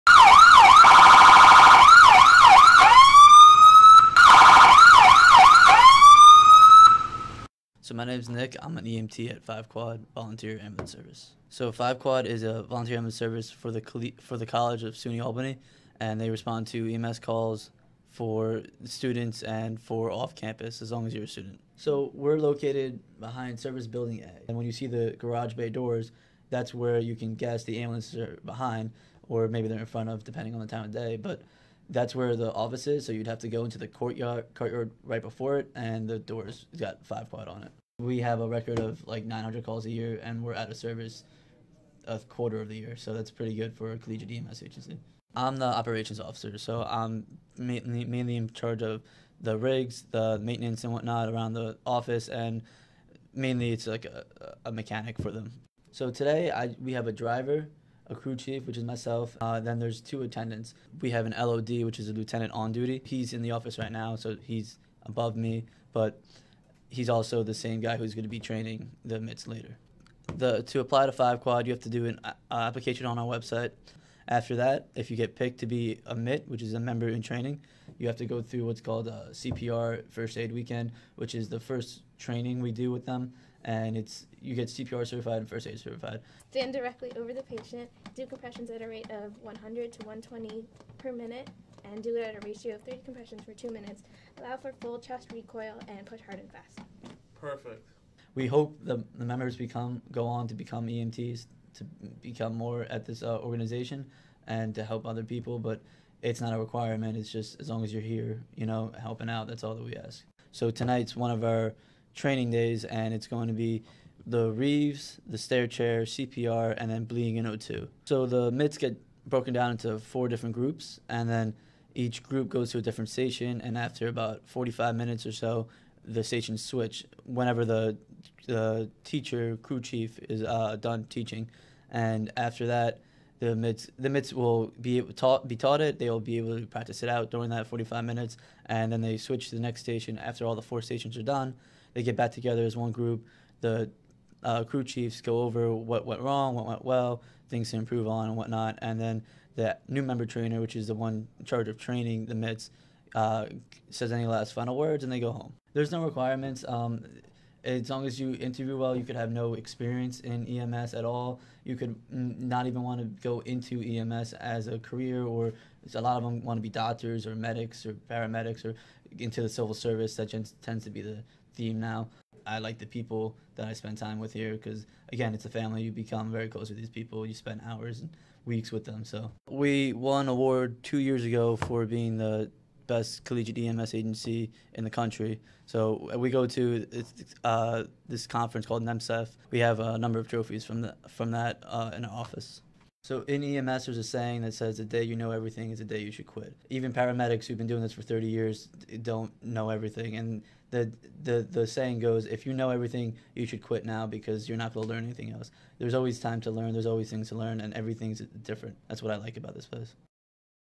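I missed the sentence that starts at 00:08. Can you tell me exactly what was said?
I'm an EMT at Five Quad Volunteer Ambulance Service.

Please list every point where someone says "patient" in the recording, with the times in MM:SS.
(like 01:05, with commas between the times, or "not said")
01:27.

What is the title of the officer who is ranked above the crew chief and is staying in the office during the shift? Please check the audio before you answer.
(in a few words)
Lieutenant on duty.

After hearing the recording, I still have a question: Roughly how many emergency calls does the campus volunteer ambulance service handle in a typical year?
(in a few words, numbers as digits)
900.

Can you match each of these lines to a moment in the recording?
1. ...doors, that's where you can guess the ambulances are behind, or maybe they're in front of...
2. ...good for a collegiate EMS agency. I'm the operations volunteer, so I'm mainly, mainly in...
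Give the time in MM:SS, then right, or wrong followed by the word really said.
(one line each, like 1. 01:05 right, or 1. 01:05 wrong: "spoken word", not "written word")
1. 00:25 right
2. 00:43 wrong: "officer", not "volunteer".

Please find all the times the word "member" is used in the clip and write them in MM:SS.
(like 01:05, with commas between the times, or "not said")
01:16, 01:39, 02:30.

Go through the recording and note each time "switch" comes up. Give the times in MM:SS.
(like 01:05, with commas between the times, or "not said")
02:06, 02:19.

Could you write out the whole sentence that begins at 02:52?
I like the people that I spend time with here because, again, it's a family.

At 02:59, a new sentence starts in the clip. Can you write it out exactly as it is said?
So we won an award two years ago for being the best collegiate EMS agency in the country.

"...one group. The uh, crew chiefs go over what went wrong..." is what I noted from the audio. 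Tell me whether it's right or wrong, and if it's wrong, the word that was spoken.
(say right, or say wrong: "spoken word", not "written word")
right.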